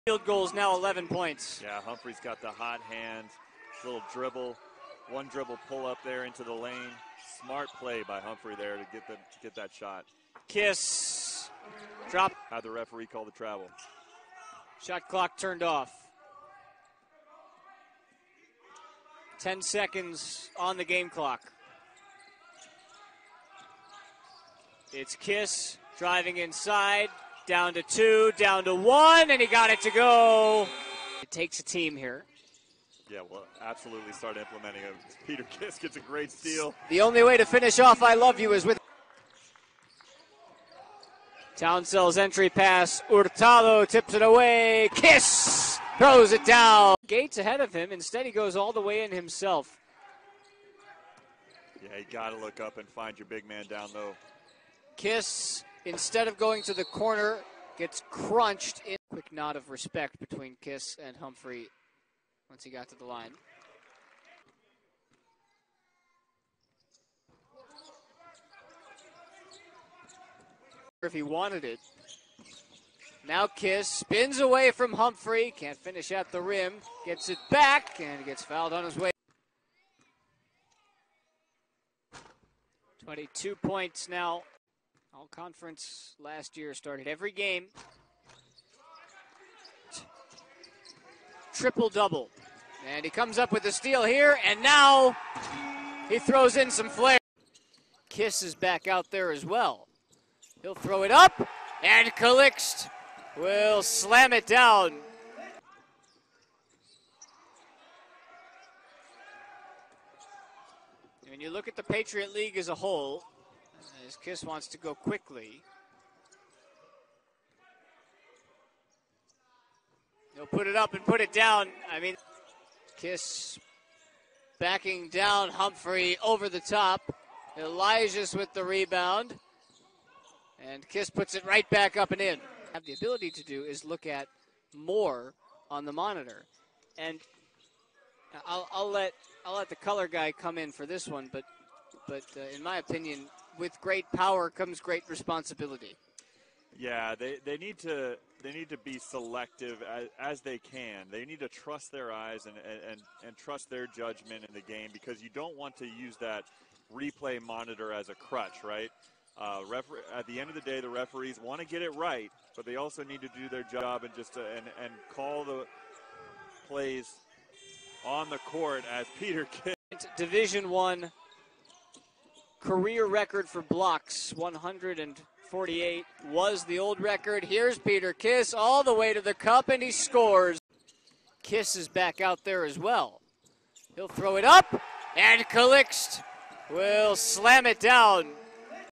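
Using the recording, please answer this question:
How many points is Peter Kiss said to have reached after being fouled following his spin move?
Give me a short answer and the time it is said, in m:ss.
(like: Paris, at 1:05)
22, at 1:23.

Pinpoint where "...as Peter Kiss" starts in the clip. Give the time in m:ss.
2:48.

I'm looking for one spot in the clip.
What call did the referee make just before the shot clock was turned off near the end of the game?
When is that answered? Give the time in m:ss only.
0:13.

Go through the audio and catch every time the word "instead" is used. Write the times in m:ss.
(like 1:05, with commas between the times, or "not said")
0:47, 0:55.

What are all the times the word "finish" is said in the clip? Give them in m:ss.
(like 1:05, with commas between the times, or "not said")
0:37, 1:15.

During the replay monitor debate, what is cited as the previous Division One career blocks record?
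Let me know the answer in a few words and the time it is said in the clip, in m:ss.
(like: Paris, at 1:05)
148, at 2:54.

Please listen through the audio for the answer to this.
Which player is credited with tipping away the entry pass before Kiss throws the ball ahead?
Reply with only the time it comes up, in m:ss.
0:43.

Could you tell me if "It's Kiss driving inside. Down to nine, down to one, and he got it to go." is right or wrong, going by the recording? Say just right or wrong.
wrong.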